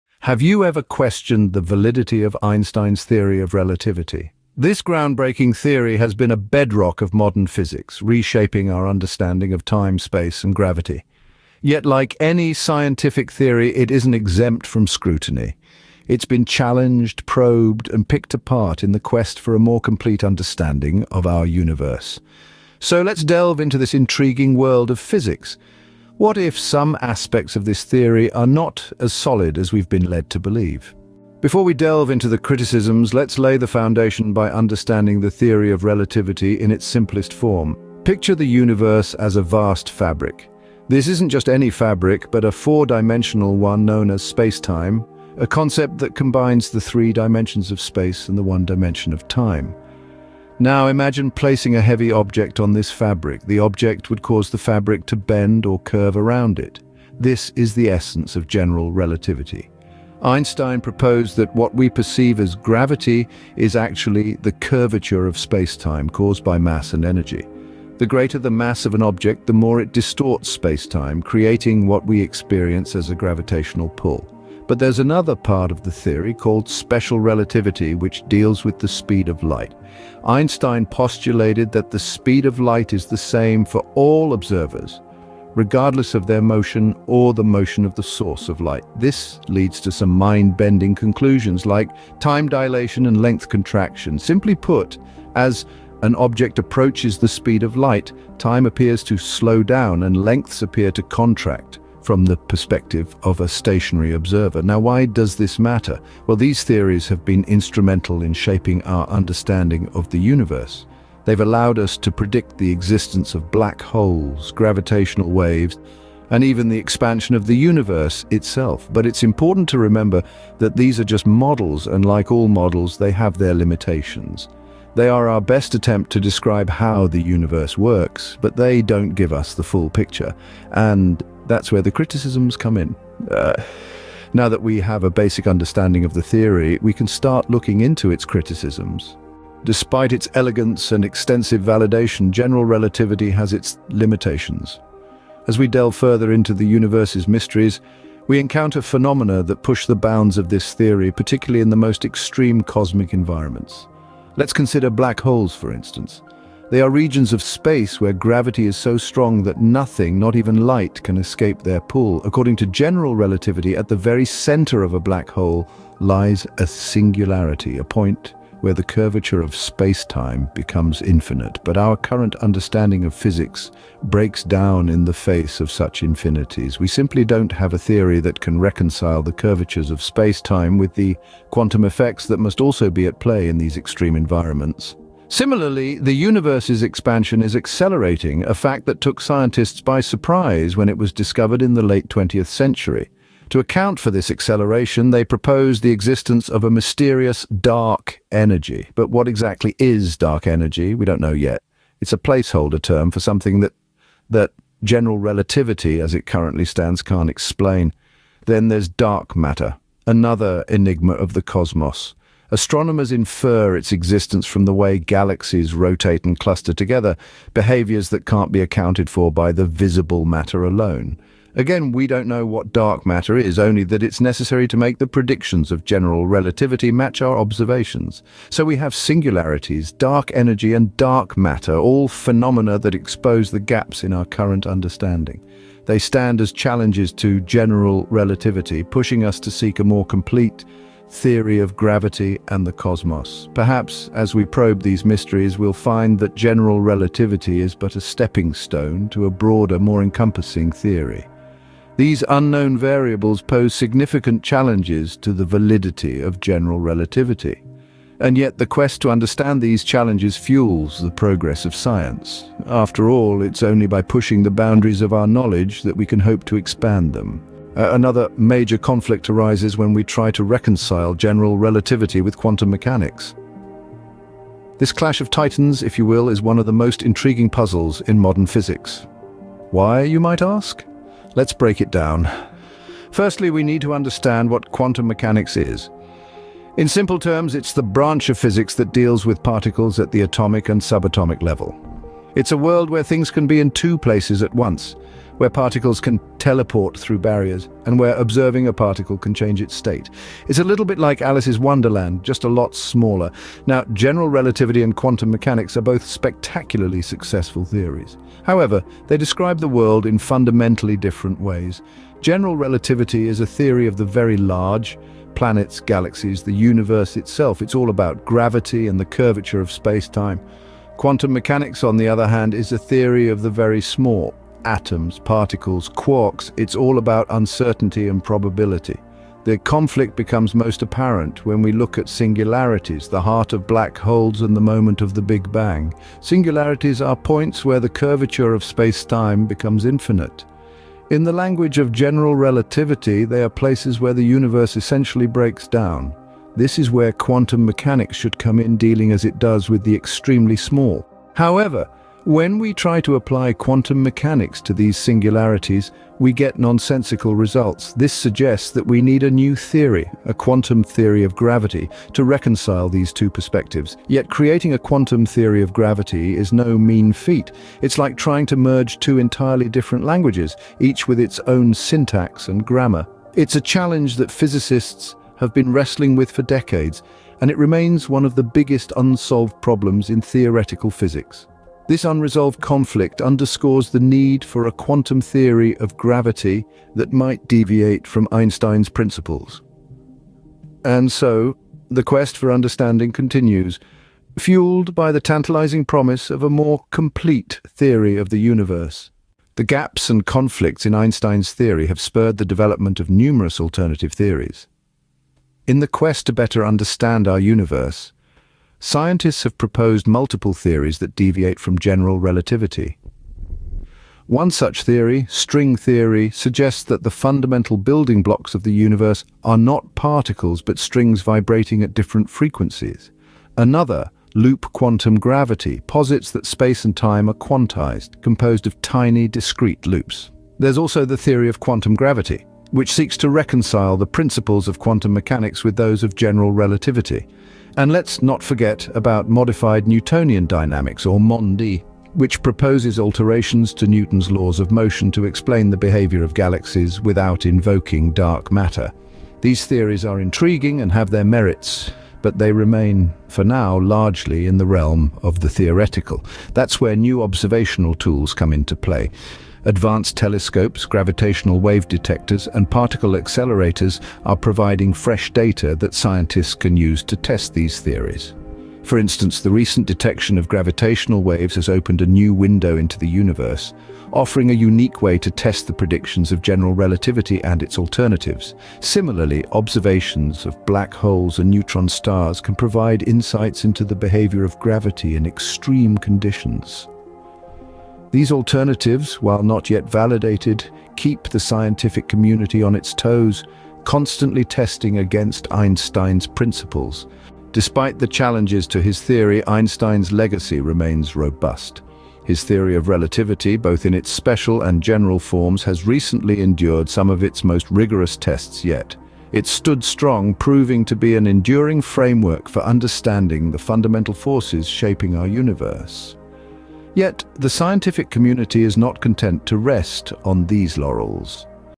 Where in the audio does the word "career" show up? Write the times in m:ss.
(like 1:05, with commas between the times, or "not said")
not said.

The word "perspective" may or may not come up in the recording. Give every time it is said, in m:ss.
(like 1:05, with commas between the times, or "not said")
1:42, 6:03.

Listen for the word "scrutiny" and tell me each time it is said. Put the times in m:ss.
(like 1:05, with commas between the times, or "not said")
0:14.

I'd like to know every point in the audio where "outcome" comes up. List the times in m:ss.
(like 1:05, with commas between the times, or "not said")
not said.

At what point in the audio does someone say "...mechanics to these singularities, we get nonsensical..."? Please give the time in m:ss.
5:54.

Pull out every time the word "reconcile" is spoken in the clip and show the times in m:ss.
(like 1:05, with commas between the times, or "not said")
2:58, 4:30, 6:02, 7:13.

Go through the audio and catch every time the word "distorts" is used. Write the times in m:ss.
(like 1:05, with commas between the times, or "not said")
1:09.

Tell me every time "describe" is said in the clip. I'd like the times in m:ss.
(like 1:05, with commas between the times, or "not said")
2:06, 5:09.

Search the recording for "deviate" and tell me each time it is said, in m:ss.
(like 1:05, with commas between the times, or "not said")
6:27, 6:51.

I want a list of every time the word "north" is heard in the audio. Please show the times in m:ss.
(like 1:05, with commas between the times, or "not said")
not said.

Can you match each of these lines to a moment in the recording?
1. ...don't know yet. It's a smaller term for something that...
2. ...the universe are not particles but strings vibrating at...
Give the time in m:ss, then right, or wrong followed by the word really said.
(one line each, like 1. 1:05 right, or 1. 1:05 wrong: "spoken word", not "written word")
1. 3:21 wrong: "placeholder", not "smaller"
2. 6:58 right.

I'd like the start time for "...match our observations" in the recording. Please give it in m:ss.
3:46.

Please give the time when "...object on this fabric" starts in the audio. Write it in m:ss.
0:52.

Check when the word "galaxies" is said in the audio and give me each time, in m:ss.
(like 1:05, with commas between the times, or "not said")
3:34, 5:15, 7:26.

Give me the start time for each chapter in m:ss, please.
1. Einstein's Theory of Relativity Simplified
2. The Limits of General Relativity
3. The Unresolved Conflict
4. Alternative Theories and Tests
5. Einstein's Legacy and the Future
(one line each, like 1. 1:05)
1. 0:31
2. 2:19
3. 4:27
4. 6:39
5. 8:17.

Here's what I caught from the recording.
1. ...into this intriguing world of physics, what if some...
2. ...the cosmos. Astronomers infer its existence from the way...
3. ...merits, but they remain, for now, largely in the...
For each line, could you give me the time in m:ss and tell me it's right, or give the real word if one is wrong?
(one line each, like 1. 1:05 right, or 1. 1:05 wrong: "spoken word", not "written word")
1. 0:23 right
2. 3:31 right
3. 7:31 right.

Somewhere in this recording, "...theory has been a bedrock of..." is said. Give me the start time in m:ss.
0:05.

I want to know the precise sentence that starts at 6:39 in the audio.
The gaps and conflicts in Einstein's theory have spurred the development of numerous alternative theories.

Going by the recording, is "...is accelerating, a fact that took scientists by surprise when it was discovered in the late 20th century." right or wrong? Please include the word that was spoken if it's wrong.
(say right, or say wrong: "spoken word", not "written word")
right.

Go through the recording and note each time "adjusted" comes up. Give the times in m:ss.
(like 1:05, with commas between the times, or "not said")
not said.